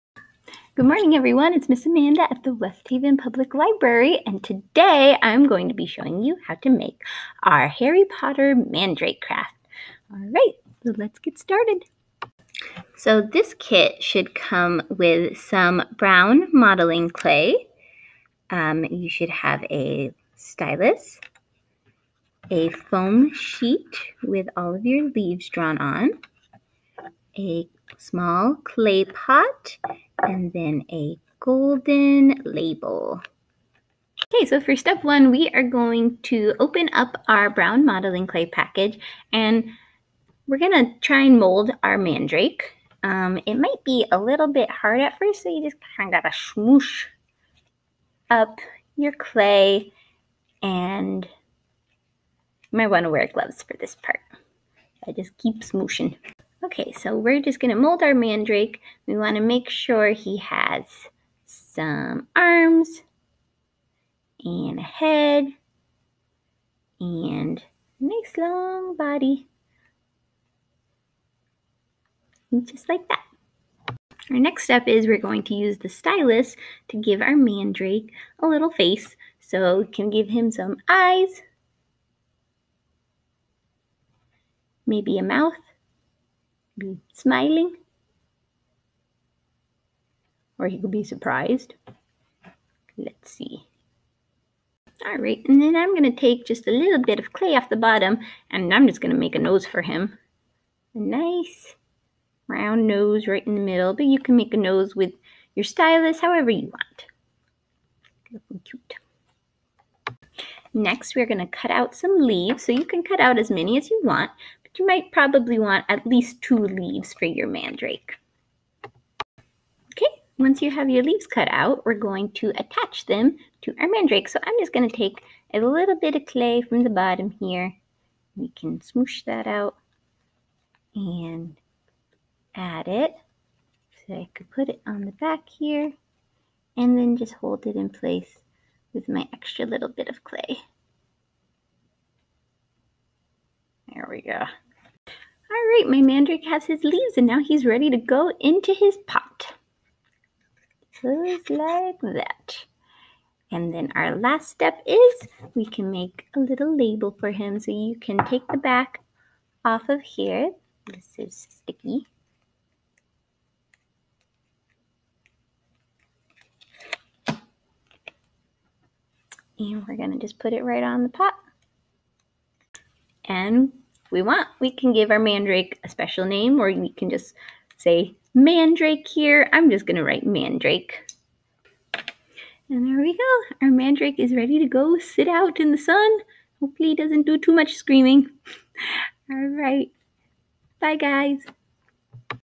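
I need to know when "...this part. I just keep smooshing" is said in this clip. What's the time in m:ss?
0:53.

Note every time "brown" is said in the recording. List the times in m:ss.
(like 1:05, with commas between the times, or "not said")
0:15, 0:37.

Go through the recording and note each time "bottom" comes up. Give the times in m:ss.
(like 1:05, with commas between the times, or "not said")
1:37, 2:06.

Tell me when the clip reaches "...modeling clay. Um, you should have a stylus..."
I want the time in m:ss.
0:16.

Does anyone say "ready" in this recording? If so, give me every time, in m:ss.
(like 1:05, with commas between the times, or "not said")
2:27, 3:04.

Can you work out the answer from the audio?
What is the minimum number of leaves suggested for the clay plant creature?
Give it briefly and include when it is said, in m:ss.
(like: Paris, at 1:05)
2, at 1:56.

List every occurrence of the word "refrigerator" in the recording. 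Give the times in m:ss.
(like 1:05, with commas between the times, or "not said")
not said.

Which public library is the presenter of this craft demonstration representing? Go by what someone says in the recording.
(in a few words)
West Haven Public Library.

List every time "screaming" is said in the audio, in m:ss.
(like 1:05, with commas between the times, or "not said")
3:07.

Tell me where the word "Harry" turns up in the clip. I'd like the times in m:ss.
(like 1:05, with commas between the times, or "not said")
0:07.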